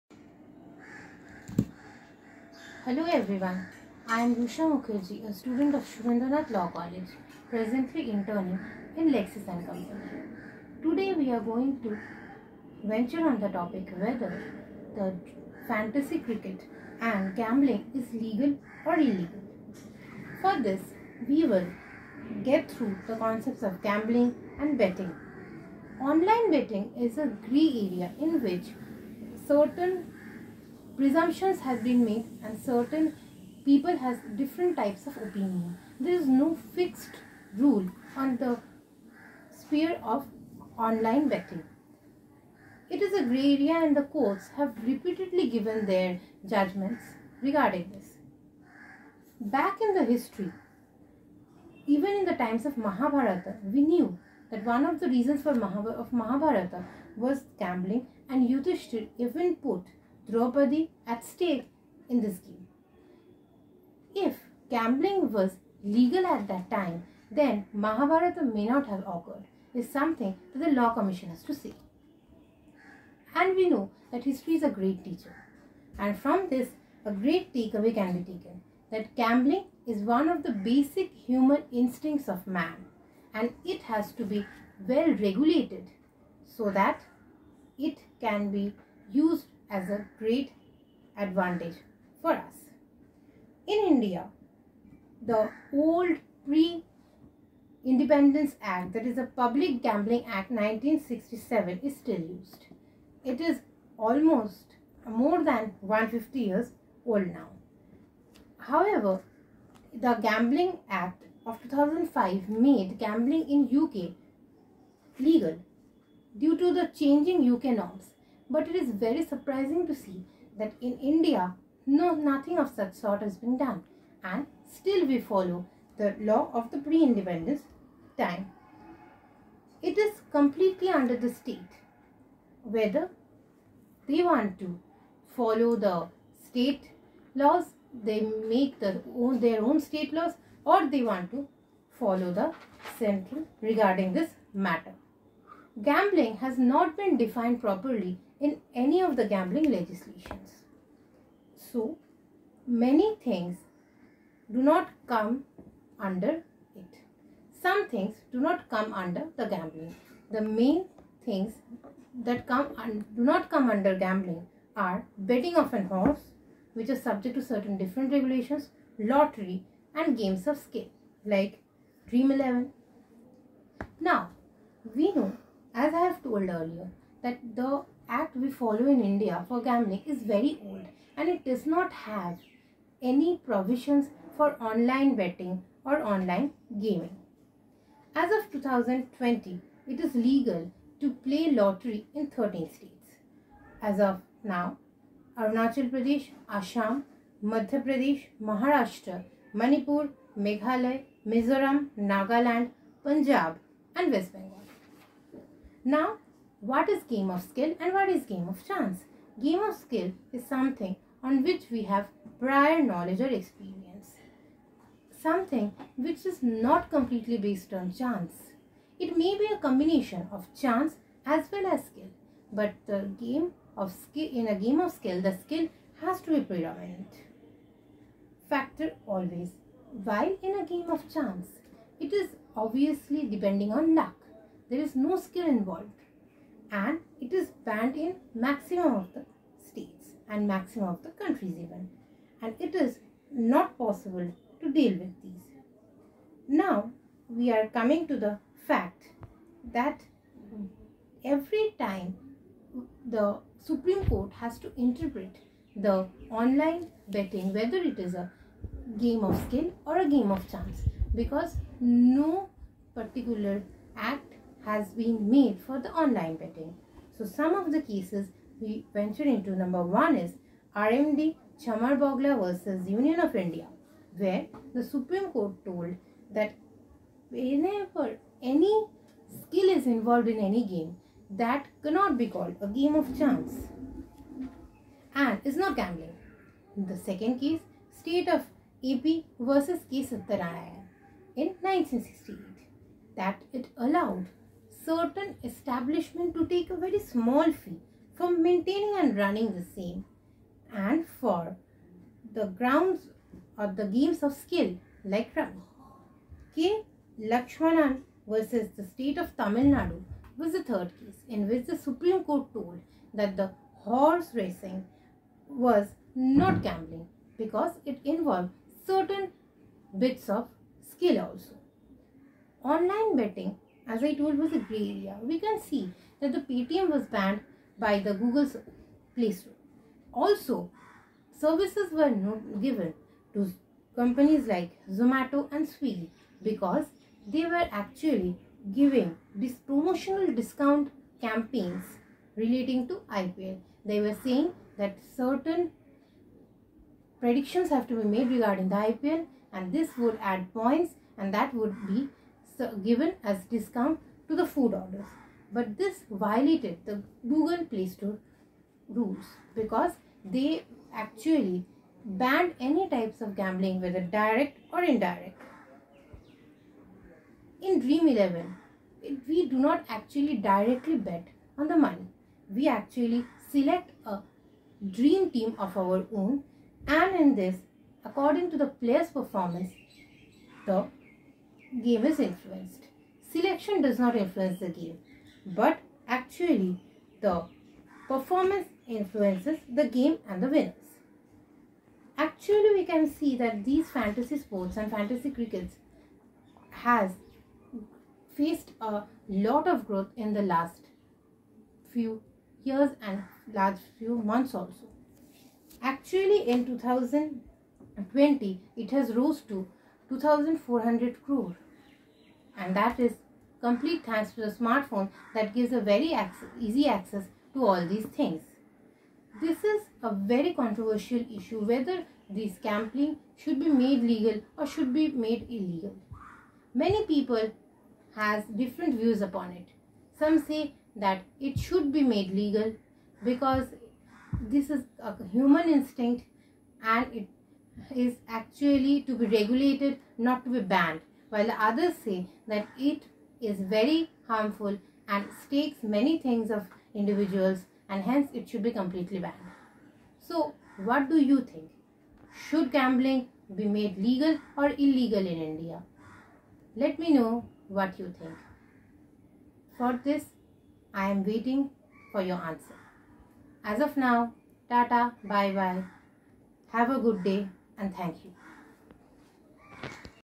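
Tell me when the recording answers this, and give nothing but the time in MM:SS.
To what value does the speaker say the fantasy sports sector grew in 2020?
06:50.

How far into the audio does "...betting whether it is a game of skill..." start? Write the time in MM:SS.
04:17.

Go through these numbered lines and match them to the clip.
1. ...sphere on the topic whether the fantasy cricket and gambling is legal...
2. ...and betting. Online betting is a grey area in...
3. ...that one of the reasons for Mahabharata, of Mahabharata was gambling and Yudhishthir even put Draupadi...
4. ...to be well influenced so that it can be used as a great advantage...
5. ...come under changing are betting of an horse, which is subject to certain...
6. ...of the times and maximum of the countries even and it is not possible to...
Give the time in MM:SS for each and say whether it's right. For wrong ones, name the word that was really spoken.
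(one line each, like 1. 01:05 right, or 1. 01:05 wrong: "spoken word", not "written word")
1. 00:12 wrong: "venture", not "sphere"
2. 00:24 right
3. 00:54 right
4. 01:24 wrong: "regulated", not "influenced"
5. 02:43 wrong: "gambling", not "changing"
6. 03:58 wrong: "states", not "times".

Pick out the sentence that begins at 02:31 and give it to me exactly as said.
So, many things do not come under it.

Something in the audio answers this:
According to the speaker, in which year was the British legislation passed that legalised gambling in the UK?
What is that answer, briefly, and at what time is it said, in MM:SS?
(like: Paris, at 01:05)
2005, at 01:51.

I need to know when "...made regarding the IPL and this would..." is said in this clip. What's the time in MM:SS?
05:48.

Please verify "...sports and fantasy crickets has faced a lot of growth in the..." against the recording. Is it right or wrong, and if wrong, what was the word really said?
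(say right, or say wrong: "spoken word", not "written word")
right.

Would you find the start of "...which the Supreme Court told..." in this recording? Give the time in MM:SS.
05:11.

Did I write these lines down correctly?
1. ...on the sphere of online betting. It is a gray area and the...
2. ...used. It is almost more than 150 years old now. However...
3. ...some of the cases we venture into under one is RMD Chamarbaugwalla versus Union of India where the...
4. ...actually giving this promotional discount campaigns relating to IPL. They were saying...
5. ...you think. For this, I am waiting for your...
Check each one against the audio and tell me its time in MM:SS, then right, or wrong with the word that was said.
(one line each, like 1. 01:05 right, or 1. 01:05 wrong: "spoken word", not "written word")
1. 00:38 right
2. 01:42 right
3. 04:27 wrong: "number", not "under"
4. 05:37 right
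5. 07:37 right.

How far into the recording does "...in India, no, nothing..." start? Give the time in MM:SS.
02:00.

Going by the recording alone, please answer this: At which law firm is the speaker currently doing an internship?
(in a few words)
Lexis and Company.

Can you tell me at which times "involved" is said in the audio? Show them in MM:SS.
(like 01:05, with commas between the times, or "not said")
03:55, 04:39, 05:18.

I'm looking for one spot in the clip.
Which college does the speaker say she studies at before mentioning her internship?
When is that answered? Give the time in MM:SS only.
00:05.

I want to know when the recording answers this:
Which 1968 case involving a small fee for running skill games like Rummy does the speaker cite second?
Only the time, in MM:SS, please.
04:47.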